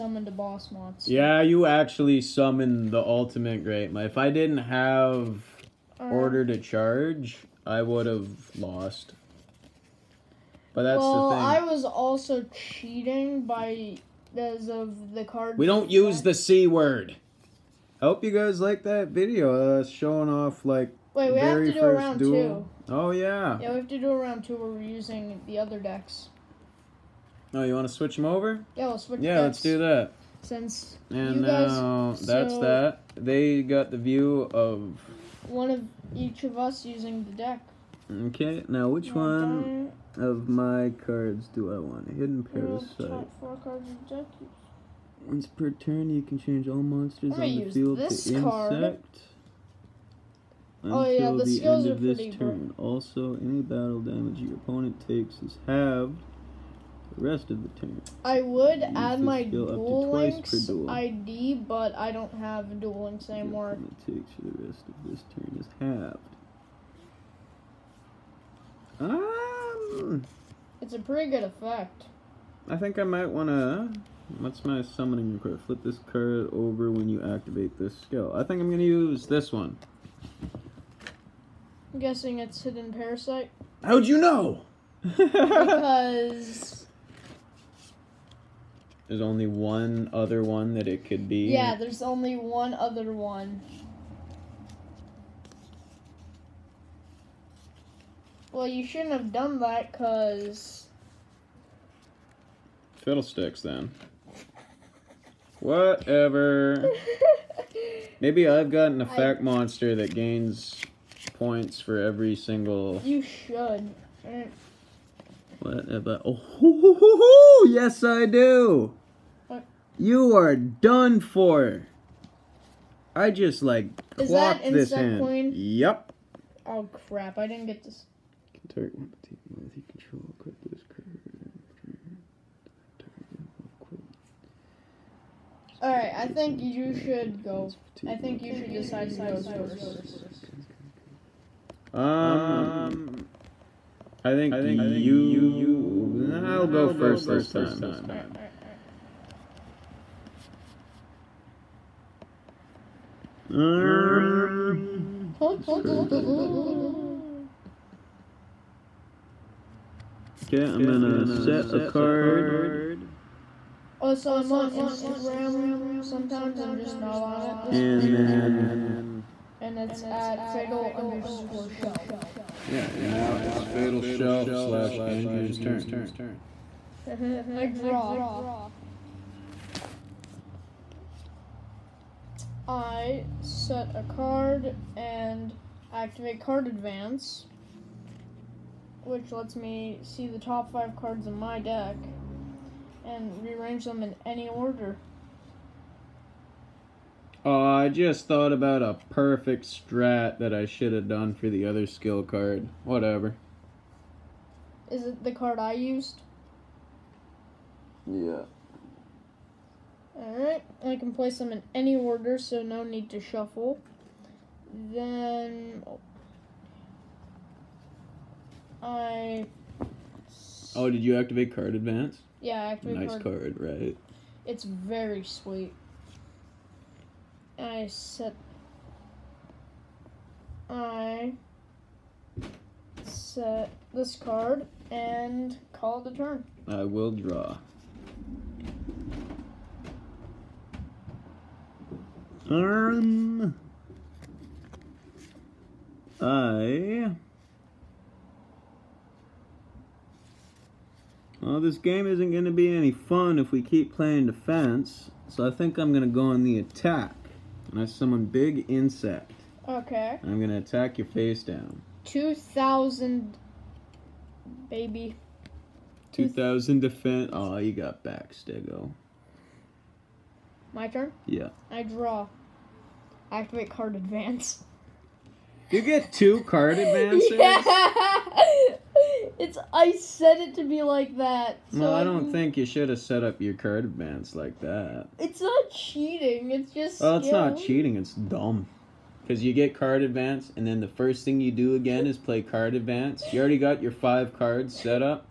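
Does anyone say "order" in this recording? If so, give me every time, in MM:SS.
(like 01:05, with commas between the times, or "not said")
00:06, 03:14, 03:31.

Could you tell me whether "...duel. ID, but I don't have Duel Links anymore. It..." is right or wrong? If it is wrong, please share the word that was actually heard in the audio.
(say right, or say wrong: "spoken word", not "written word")
right.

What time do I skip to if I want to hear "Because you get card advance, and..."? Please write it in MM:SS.
04:49.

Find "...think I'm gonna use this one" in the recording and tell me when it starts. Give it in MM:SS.
01:18.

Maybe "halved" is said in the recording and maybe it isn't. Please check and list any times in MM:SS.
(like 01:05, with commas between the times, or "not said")
00:55, 01:05.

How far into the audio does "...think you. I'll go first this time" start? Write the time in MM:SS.
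02:24.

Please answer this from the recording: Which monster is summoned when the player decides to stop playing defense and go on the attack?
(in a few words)
Big Insect.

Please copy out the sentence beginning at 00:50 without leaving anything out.
Until oh, yeah, the, the end of this turn.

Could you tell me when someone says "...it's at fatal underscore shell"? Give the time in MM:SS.
02:49.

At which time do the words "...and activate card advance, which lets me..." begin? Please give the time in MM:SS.
03:04.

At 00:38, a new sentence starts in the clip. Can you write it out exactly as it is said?
Okay, now which now one of my cards do I want?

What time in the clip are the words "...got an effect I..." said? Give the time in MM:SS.
01:48.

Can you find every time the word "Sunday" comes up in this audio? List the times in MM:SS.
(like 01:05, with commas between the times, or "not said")
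not said.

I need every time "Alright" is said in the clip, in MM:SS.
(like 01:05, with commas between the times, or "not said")
02:15, 03:30.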